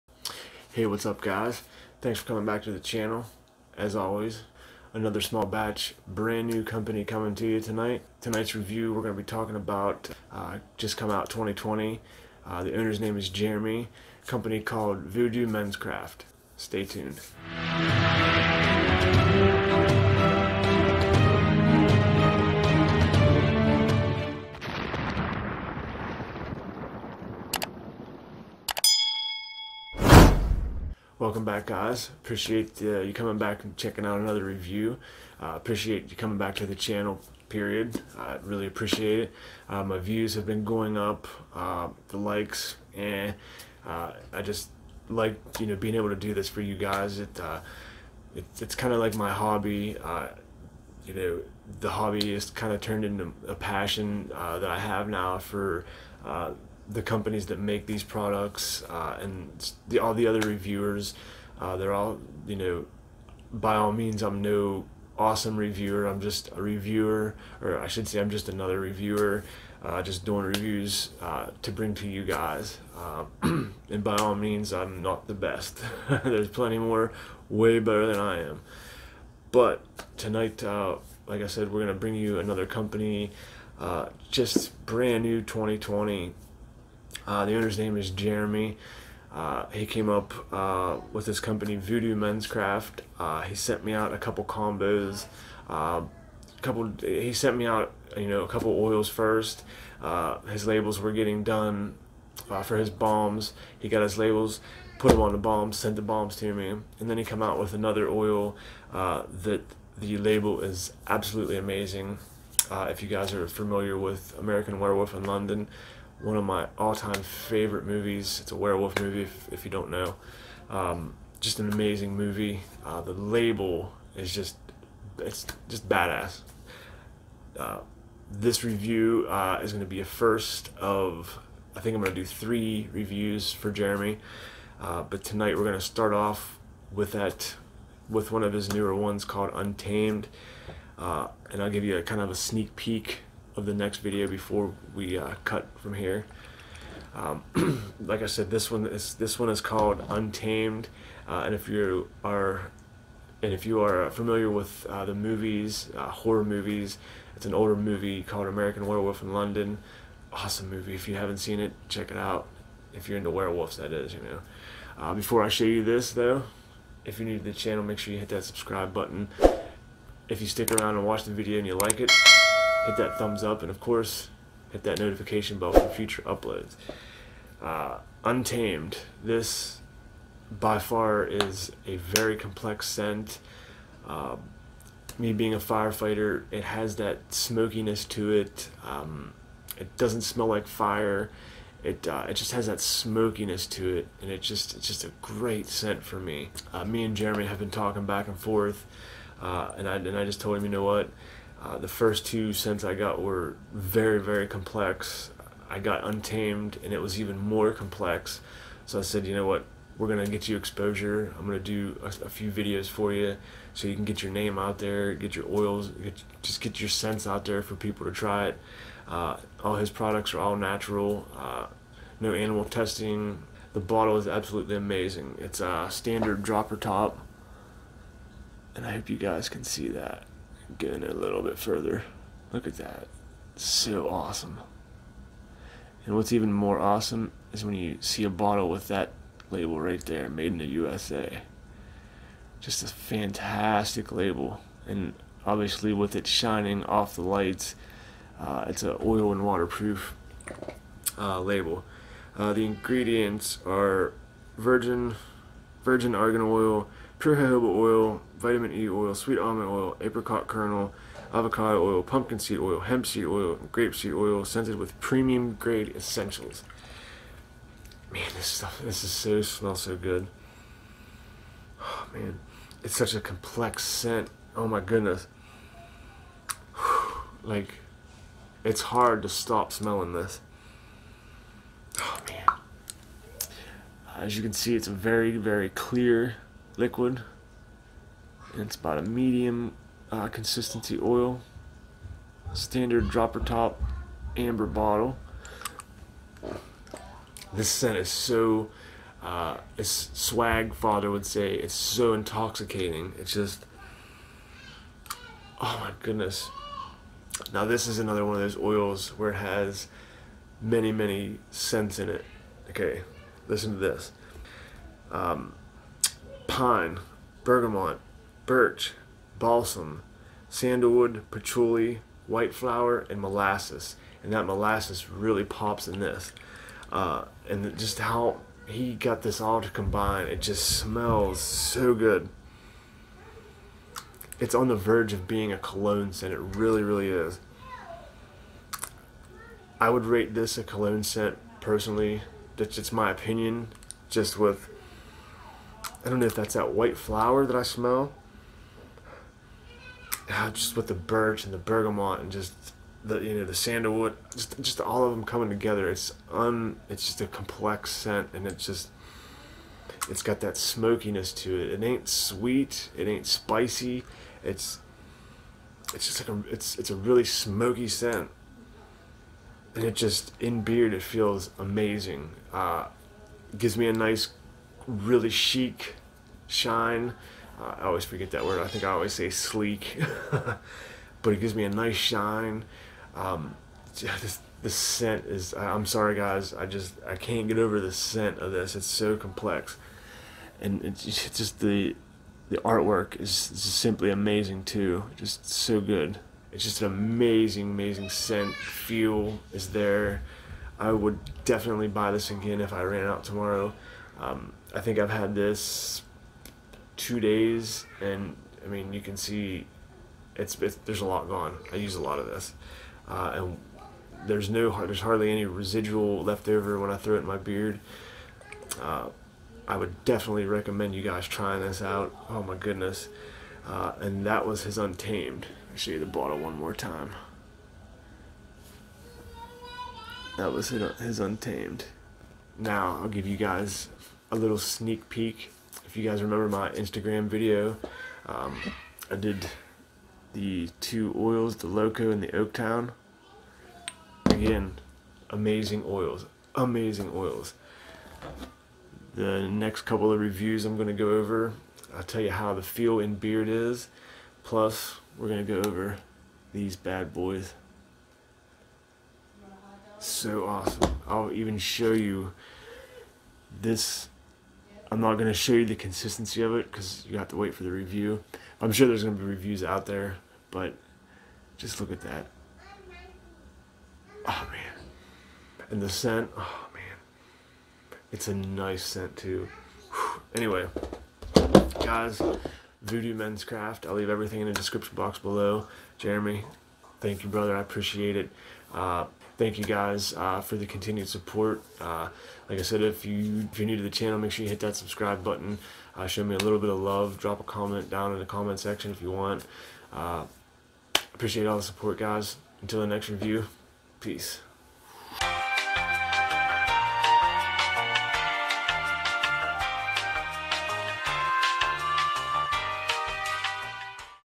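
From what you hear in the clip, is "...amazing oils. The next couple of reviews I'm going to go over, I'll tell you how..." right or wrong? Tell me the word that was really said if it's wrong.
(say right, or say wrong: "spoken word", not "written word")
right.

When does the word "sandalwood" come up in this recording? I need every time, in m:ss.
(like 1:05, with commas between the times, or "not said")
5:20, 5:53.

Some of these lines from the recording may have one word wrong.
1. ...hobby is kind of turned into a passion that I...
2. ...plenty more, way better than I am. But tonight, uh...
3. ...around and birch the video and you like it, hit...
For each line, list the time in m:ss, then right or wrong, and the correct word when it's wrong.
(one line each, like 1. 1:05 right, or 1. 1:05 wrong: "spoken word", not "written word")
1. 0:51 right
2. 1:16 right
3. 2:50 wrong: "watch", not "birch".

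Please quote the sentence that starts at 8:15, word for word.
Uh, show me a little bit of love.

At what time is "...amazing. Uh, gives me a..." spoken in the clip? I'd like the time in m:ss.
6:11.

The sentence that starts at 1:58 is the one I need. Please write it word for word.
It's a werewolf movie, if, if you don't know.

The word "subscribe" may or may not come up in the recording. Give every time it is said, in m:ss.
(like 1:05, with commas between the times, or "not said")
2:48, 8:14.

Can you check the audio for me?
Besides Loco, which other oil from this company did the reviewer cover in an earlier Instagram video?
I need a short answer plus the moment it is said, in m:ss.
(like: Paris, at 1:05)
Oaktown, at 7:21.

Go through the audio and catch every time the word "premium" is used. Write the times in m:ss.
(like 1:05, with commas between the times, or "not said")
4:24.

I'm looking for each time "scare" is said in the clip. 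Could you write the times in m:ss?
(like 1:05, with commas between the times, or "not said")
not said.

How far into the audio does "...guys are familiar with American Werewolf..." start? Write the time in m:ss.
1:53.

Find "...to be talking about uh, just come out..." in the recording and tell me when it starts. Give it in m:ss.
0:09.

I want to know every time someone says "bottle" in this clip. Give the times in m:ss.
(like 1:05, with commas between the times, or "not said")
3:43, 3:58, 4:54, 7:06.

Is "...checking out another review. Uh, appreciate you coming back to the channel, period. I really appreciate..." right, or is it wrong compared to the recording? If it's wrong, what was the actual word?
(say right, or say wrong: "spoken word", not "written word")
right.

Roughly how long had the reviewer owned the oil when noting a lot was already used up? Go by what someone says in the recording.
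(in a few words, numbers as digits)
2 days.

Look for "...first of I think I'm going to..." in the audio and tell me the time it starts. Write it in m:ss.
2:10.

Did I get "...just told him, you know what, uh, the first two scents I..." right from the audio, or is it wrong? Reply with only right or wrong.
right.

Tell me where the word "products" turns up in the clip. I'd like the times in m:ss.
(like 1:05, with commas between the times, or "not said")
0:58, 3:39.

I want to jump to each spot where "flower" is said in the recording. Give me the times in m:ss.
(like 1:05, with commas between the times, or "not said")
5:22, 5:46.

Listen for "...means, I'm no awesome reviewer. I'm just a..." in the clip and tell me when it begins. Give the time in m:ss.
1:03.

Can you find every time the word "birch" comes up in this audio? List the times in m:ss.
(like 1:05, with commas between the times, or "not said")
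5:18, 5:50.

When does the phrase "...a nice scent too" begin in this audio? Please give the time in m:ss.
7:58.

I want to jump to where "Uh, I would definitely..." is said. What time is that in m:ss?
6:58.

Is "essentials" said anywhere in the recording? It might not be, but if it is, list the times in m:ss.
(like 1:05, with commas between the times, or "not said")
4:25.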